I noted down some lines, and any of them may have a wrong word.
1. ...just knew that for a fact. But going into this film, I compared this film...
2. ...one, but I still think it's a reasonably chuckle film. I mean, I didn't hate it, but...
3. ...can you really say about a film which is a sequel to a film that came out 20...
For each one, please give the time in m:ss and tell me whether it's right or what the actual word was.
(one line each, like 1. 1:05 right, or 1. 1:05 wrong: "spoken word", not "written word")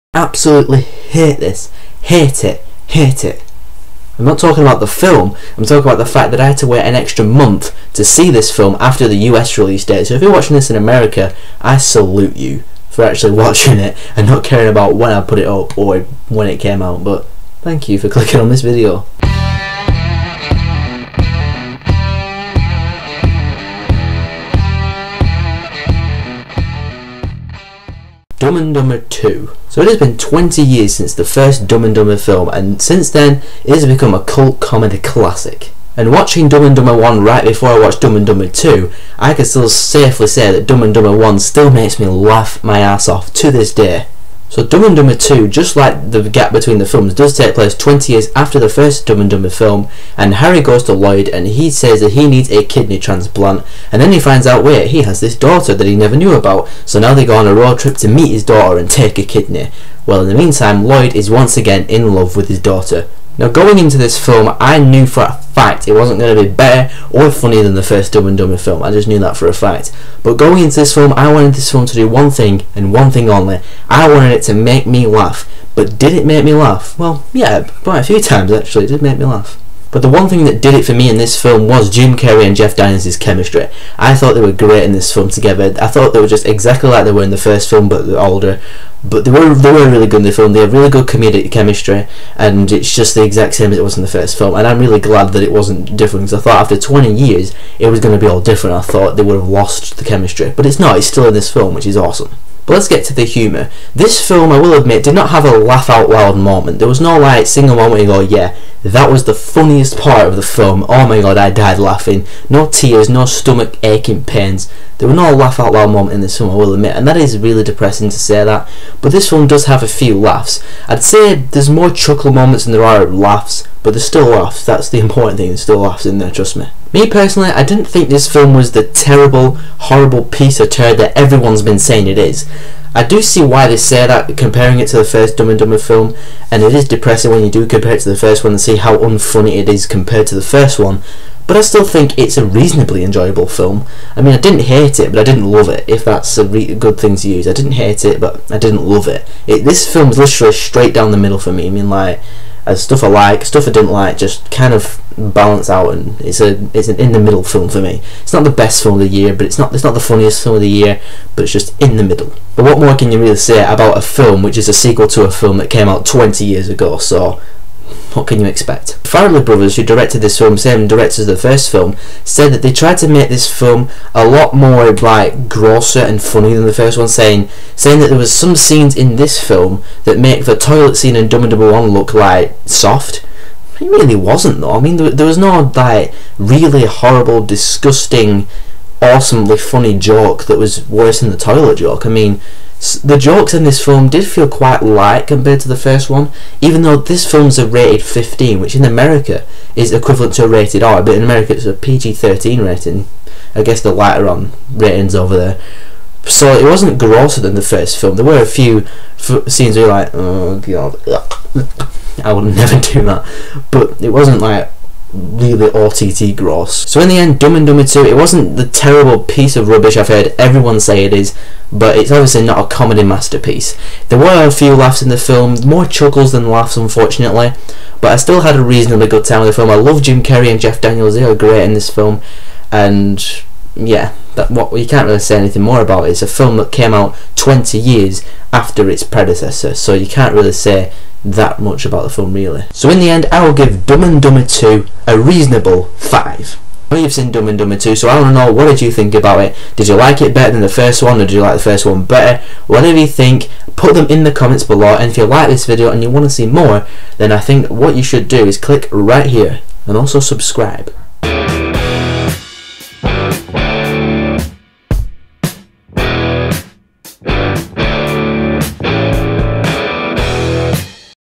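1. 1:08 wrong: "wanted", not "compared"
2. 2:20 wrong: "enjoyable", not "chuckle"
3. 2:42 right.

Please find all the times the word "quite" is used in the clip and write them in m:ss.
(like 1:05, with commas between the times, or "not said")
1:17, 3:14.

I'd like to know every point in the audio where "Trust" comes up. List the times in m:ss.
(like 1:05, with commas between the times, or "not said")
2:06.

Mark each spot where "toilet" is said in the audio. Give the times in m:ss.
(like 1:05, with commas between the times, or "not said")
3:00, 3:11.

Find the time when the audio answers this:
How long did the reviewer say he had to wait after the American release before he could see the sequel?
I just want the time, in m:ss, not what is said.
0:06.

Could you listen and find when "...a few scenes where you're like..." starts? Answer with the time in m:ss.
3:28.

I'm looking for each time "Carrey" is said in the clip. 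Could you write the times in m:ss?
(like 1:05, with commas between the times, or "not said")
1:22, 3:50.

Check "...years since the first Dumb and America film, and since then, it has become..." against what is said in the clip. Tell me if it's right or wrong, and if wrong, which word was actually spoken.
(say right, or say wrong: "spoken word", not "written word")
wrong: "Dumber", not "America".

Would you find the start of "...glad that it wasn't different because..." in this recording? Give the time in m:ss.
1:35.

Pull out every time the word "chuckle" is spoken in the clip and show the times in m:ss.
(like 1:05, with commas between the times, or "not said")
2:01, 3:45.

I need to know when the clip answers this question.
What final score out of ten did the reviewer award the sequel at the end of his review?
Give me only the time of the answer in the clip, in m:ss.
4:05.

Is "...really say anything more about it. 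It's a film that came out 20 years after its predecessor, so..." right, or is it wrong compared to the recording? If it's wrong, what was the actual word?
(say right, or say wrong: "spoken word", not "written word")
right.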